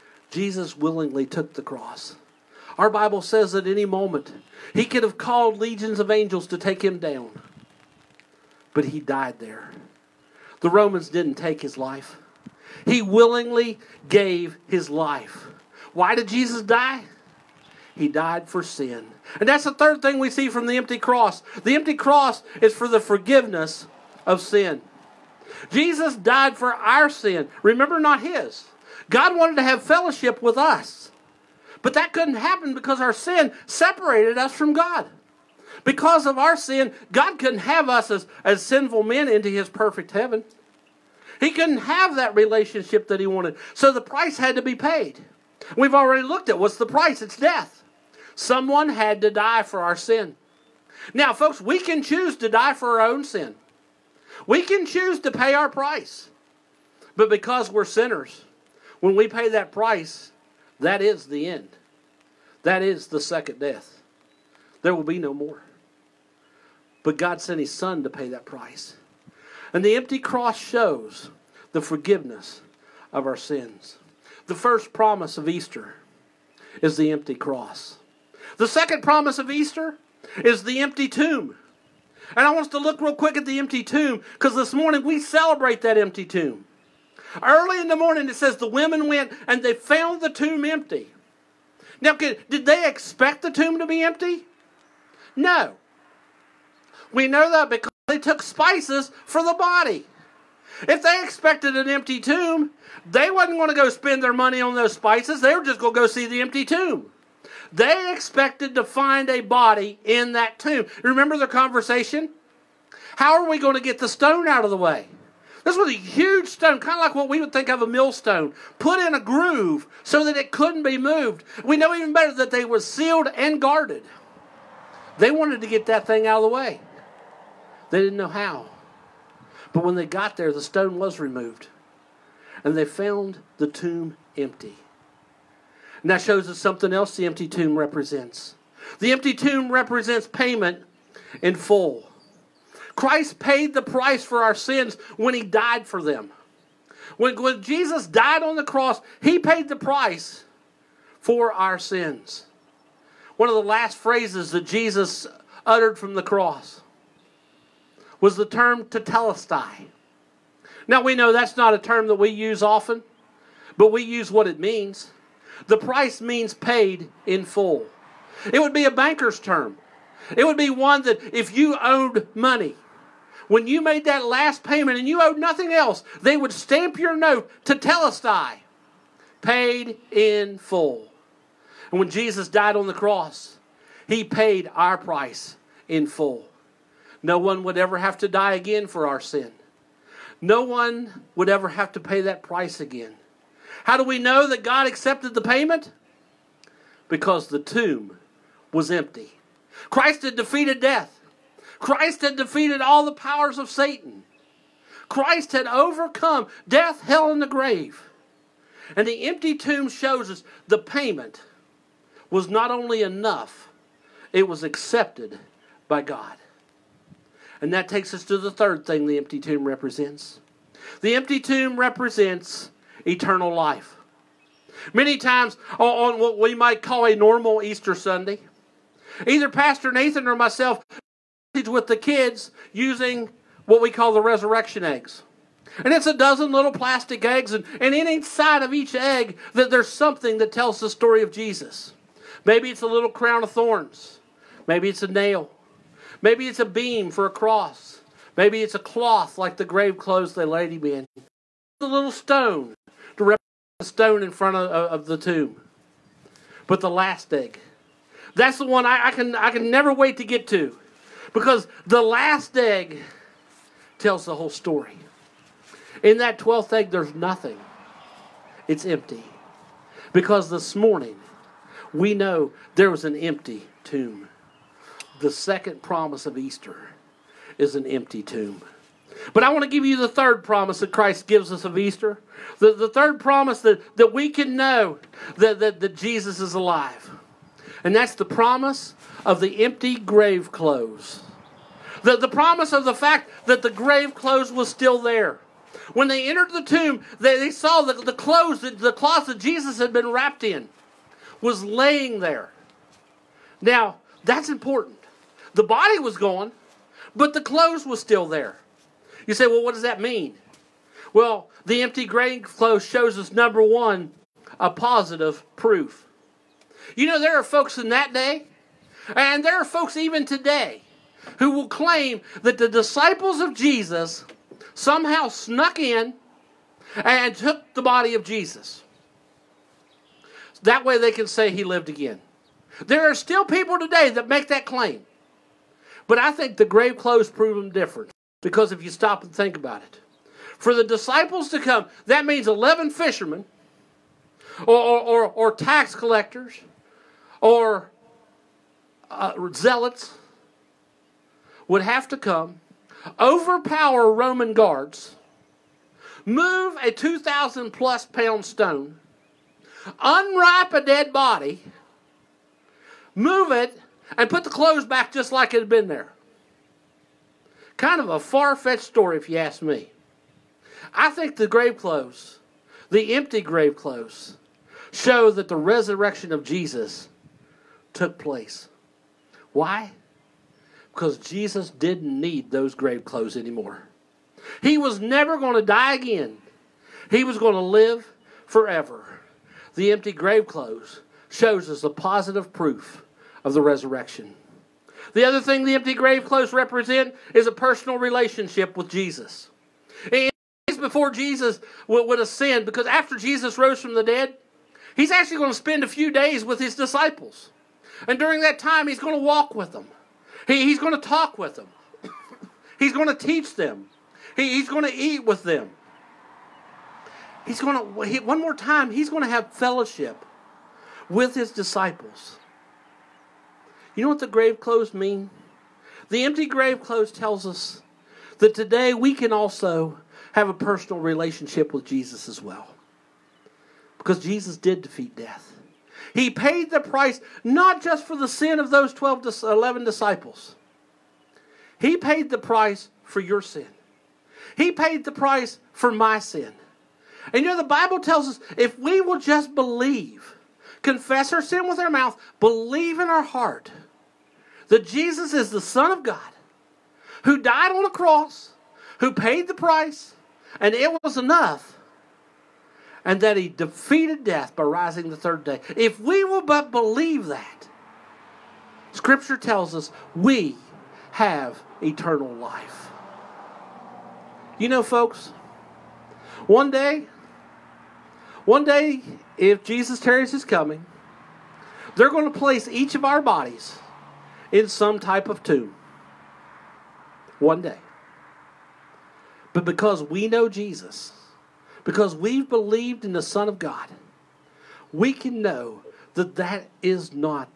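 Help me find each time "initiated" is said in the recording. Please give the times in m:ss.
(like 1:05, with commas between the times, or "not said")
not said.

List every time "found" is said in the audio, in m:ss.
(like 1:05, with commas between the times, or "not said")
1:29, 2:12.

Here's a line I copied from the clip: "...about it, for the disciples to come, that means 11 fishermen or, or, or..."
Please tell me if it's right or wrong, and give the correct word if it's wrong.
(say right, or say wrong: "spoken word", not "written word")
right.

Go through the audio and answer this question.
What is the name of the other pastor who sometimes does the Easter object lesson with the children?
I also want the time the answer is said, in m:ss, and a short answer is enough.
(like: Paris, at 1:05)
Pastor Nathan, at 3:49.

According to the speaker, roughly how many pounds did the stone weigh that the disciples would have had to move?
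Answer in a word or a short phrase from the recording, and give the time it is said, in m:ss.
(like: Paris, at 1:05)
2,000 plus, at 5:56.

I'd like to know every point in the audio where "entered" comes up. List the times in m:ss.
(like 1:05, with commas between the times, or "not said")
4:56.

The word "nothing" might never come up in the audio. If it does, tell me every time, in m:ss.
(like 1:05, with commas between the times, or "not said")
2:55, 4:27.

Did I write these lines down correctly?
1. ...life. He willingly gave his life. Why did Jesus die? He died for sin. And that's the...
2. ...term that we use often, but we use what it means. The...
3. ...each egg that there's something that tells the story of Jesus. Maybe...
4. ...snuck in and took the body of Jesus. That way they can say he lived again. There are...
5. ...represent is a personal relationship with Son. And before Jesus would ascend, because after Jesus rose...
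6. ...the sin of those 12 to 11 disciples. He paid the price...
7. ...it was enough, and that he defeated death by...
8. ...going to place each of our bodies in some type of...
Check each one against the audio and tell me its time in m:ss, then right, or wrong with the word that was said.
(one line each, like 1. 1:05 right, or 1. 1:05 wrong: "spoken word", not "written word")
1. 0:11 right
2. 2:41 right
3. 3:58 right
4. 5:25 right
5. 6:36 wrong: "Jesus", not "Son"
6. 7:18 right
7. 7:40 right
8. 8:02 right.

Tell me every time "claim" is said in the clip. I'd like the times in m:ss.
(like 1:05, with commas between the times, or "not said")
5:21, 5:34.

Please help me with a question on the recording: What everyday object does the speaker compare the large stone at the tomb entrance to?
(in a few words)
A millstone.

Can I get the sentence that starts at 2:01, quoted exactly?
We know even better that they were sealed and guarded.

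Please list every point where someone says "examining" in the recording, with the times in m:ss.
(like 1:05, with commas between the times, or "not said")
not said.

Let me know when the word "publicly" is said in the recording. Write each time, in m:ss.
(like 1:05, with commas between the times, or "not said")
not said.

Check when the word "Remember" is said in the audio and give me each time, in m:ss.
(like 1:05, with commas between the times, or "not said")
0:27, 1:51.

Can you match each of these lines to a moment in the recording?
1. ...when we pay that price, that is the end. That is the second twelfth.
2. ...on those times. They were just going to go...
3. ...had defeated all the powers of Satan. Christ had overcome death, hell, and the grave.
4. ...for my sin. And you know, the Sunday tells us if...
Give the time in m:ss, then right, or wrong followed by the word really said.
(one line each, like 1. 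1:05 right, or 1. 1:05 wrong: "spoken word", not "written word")
1. 0:59 wrong: "death", not "twelfth"
2. 1:44 wrong: "spices", not "times"
3. 3:22 right
4. 7:25 wrong: "Bible", not "Sunday".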